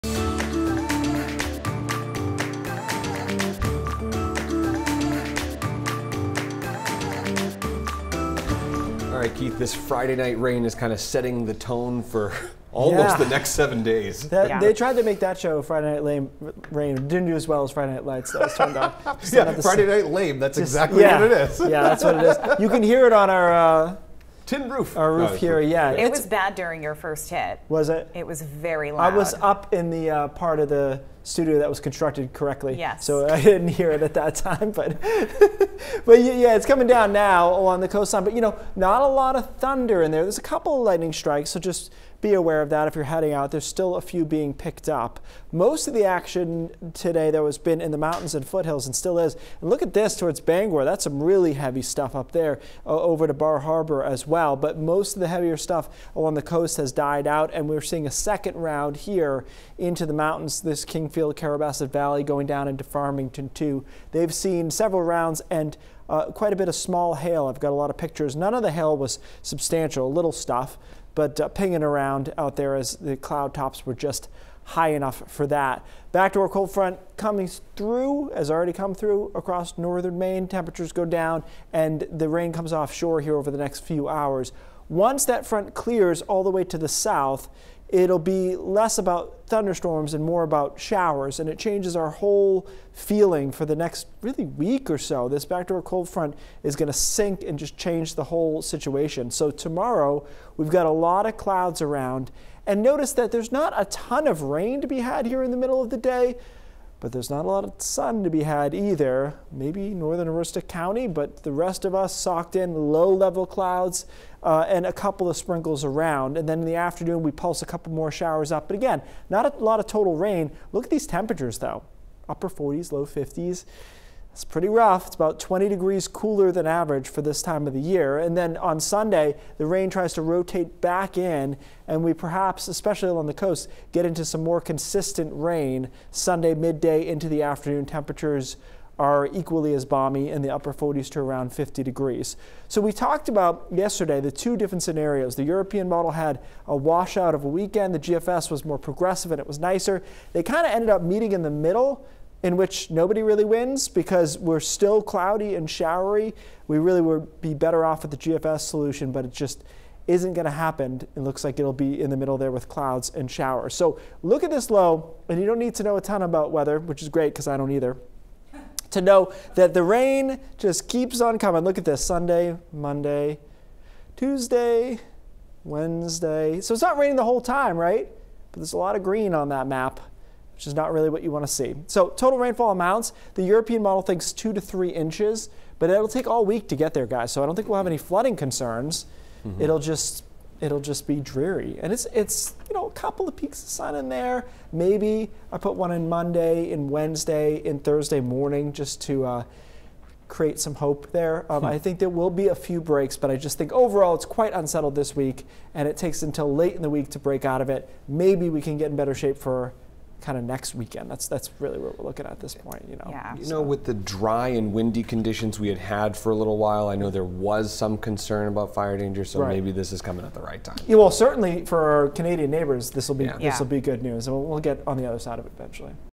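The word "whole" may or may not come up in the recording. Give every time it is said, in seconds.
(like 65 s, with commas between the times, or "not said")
92 s, 98 s, 177 s.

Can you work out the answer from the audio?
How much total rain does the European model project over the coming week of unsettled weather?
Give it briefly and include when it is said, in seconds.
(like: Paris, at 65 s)
2 to 3 inches, at 184 s.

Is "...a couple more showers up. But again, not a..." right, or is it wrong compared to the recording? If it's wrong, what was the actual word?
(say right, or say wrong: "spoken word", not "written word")
right.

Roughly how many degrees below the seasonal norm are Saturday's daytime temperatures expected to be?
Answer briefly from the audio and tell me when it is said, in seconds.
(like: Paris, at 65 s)
20 degrees, at 125 s.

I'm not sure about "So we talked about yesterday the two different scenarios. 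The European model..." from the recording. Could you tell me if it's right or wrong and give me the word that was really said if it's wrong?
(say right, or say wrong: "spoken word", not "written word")
right.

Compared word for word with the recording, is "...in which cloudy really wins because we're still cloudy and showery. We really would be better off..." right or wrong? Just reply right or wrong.
wrong.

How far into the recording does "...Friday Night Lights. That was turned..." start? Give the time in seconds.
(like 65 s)
17 s.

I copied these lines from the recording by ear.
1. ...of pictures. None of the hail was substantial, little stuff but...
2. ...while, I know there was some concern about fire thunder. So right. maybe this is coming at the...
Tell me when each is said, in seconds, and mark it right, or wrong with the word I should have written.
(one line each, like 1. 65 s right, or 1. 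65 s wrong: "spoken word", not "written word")
1. 67 s right
2. 216 s wrong: "danger", not "thunder".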